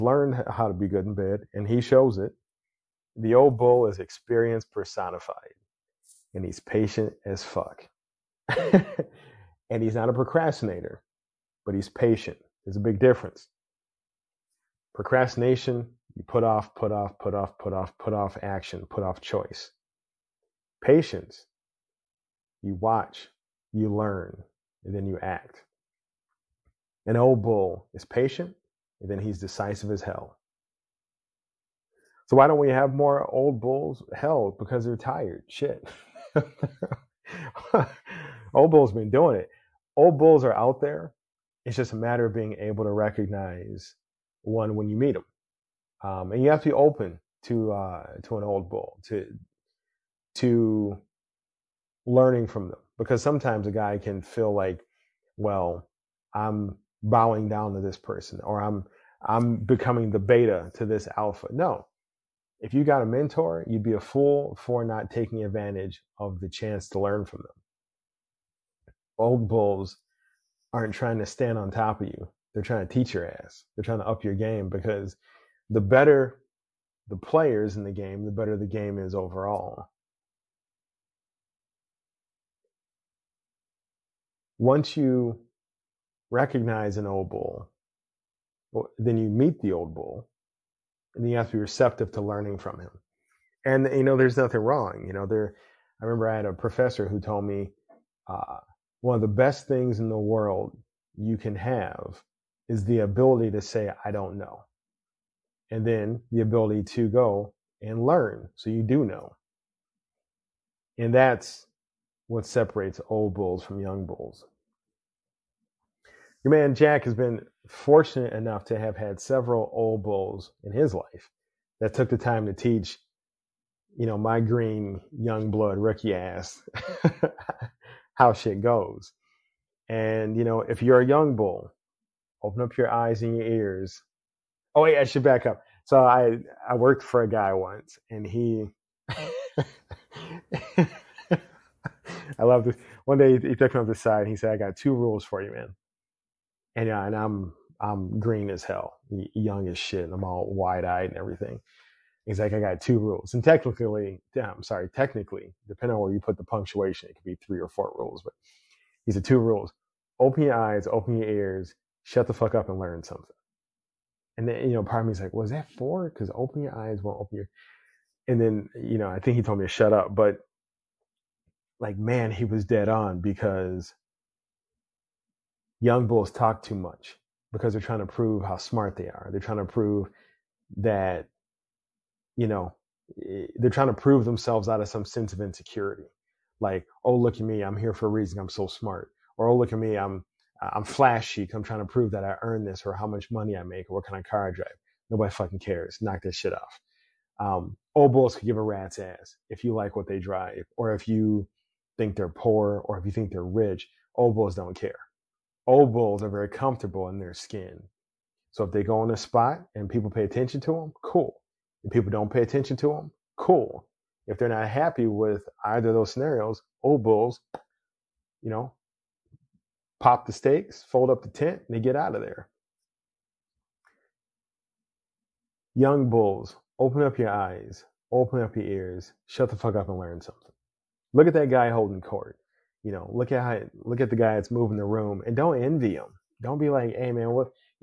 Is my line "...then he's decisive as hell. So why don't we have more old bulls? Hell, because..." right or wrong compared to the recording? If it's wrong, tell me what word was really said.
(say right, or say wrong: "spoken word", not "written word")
right.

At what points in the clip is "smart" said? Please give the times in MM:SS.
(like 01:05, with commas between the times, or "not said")
02:58, 03:08.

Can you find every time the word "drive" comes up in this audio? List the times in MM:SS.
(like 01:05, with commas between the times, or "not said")
03:14, 03:20.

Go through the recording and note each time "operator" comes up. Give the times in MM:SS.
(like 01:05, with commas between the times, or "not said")
not said.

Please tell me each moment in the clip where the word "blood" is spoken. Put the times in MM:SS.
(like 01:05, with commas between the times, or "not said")
02:05.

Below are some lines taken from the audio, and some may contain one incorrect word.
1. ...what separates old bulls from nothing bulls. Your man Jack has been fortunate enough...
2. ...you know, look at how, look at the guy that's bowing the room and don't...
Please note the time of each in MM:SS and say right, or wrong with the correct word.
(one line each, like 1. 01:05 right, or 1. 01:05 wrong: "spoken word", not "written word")
1. 01:52 wrong: "young", not "nothing"
2. 03:52 wrong: "moving", not "bowing".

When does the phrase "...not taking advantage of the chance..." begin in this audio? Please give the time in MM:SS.
01:04.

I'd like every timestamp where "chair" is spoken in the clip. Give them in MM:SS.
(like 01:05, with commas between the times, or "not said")
not said.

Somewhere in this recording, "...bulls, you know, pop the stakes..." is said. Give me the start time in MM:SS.
03:37.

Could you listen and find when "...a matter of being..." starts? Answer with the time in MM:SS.
00:41.